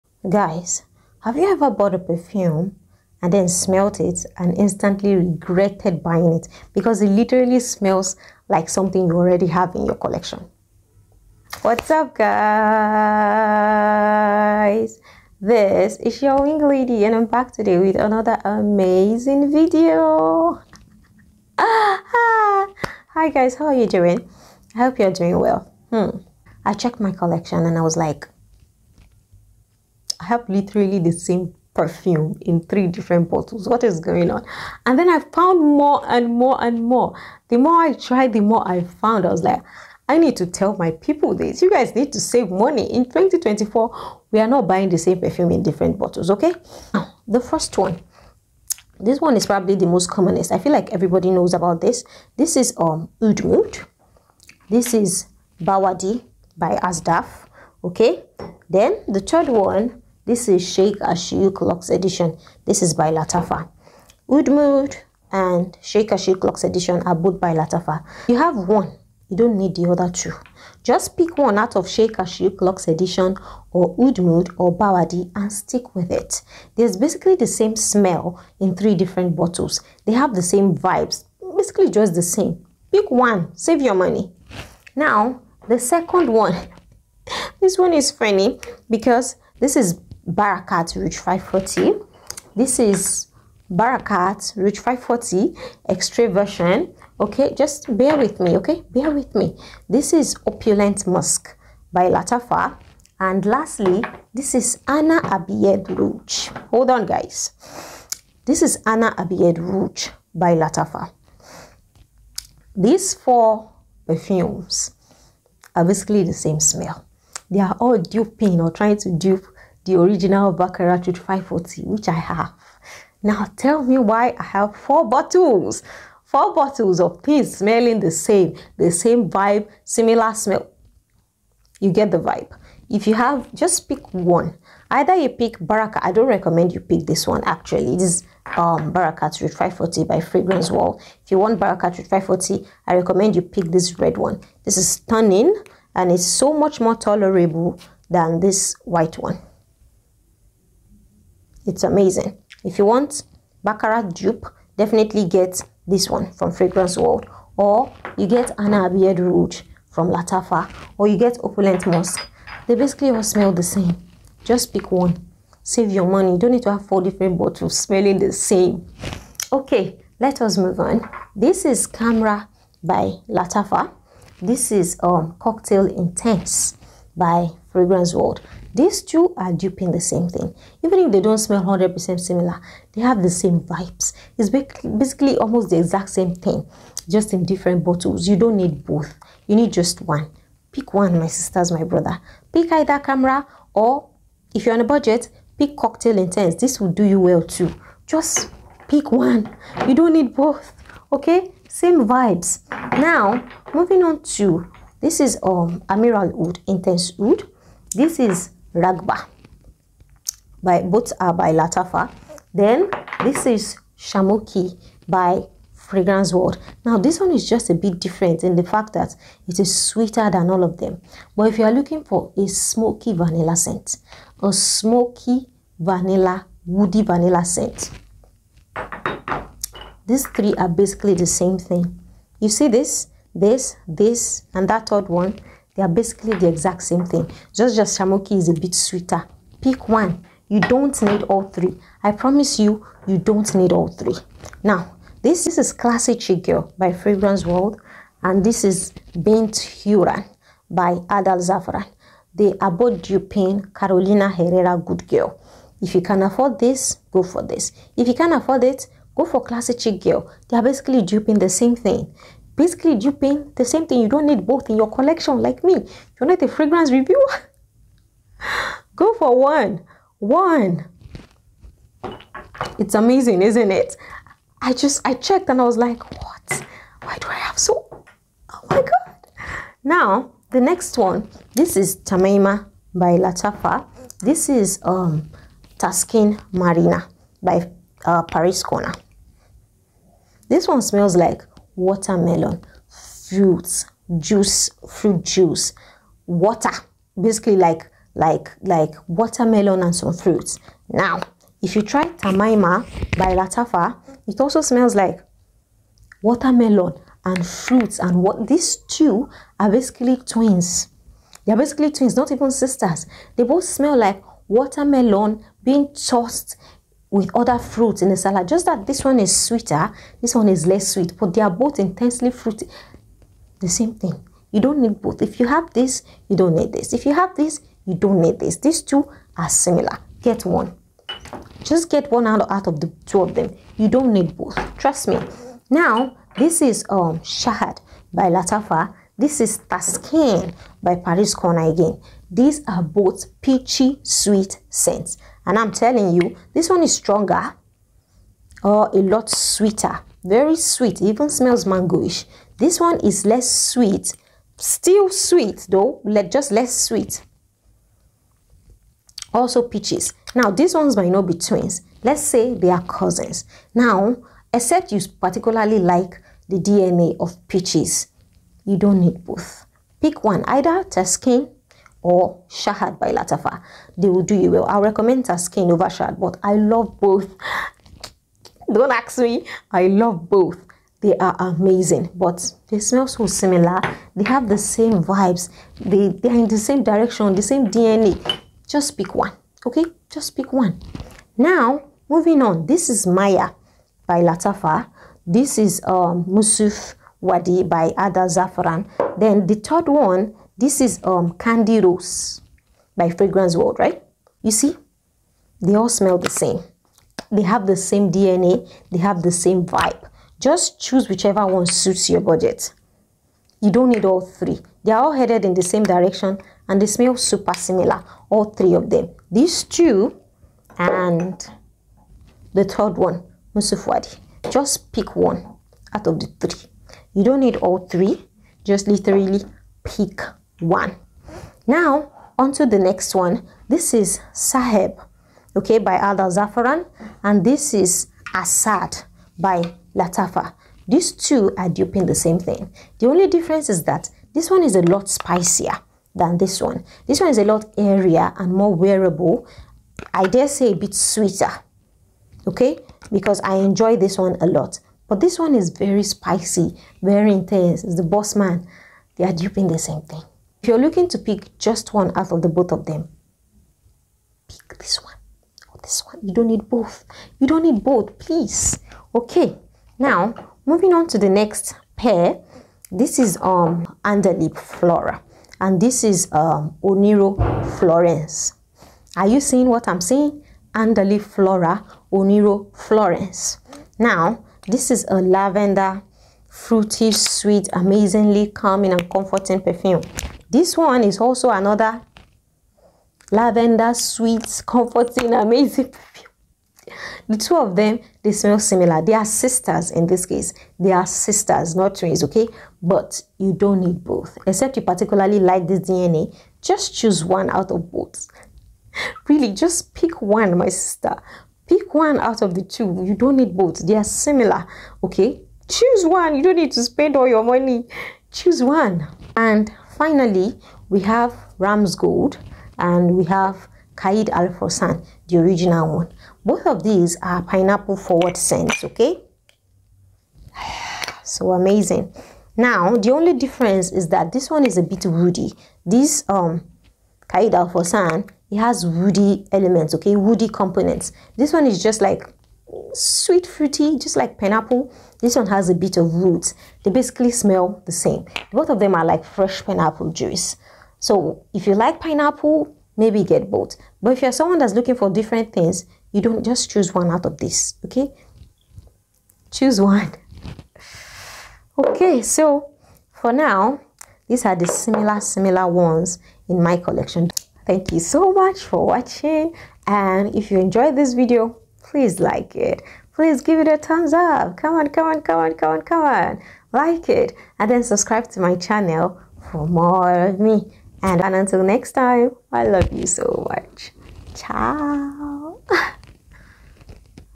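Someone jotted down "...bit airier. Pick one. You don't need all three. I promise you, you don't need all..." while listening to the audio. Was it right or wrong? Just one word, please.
wrong.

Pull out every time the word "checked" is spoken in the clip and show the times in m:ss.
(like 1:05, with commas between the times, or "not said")
0:26, 4:35.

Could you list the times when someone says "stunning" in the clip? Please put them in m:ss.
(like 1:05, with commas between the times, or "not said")
2:24.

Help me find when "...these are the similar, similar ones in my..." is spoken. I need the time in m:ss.
9:24.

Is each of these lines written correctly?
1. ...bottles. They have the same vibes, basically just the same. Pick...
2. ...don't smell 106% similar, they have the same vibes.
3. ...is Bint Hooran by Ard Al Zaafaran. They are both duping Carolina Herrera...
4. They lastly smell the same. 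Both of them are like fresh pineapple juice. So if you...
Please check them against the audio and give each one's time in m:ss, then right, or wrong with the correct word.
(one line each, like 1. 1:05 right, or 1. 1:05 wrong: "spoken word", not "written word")
1. 1:19 right
2. 3:01 wrong: "100", not "106"
3. 4:08 right
4. 9:06 wrong: "basically", not "lastly".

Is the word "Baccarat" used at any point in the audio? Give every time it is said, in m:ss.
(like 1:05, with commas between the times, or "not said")
2:00, 2:33.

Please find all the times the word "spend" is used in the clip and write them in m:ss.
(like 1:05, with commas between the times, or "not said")
8:36.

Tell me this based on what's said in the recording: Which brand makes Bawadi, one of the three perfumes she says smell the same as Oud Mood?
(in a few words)
Asdaaf.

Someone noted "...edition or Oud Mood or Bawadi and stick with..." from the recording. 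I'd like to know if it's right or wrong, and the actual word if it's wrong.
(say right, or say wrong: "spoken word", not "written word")
right.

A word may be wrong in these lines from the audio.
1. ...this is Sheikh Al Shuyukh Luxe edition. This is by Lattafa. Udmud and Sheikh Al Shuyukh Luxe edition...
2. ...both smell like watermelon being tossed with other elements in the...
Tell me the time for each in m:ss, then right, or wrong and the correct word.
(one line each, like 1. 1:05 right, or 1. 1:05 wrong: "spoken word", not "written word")
1. 1:00 right
2. 5:13 wrong: "fruits", not "elements".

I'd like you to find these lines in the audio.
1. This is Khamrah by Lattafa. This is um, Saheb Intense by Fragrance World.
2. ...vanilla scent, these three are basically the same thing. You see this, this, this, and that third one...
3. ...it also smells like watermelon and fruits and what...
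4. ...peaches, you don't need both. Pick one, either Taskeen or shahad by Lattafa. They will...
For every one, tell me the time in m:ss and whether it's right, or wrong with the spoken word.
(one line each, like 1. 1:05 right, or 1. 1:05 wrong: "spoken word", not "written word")
1. 2:51 wrong: "Cocktail", not "Saheb"
2. 3:47 right
3. 5:04 right
4. 6:07 right.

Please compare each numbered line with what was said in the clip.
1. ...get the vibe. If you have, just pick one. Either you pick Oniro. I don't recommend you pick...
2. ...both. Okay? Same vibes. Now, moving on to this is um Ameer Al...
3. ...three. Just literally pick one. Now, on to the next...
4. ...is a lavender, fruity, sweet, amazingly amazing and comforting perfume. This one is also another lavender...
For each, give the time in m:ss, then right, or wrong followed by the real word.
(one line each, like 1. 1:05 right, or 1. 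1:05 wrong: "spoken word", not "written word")
1. 2:11 wrong: "Baraka", not "Oniro"
2. 3:20 right
3. 7:07 right
4. 8:04 wrong: "calming", not "amazing".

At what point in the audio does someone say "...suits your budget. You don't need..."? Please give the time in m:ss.
6:51.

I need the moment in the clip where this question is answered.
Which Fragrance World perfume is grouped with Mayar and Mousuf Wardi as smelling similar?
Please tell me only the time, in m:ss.
6:41.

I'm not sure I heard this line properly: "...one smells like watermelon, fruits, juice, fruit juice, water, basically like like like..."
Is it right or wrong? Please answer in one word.
right.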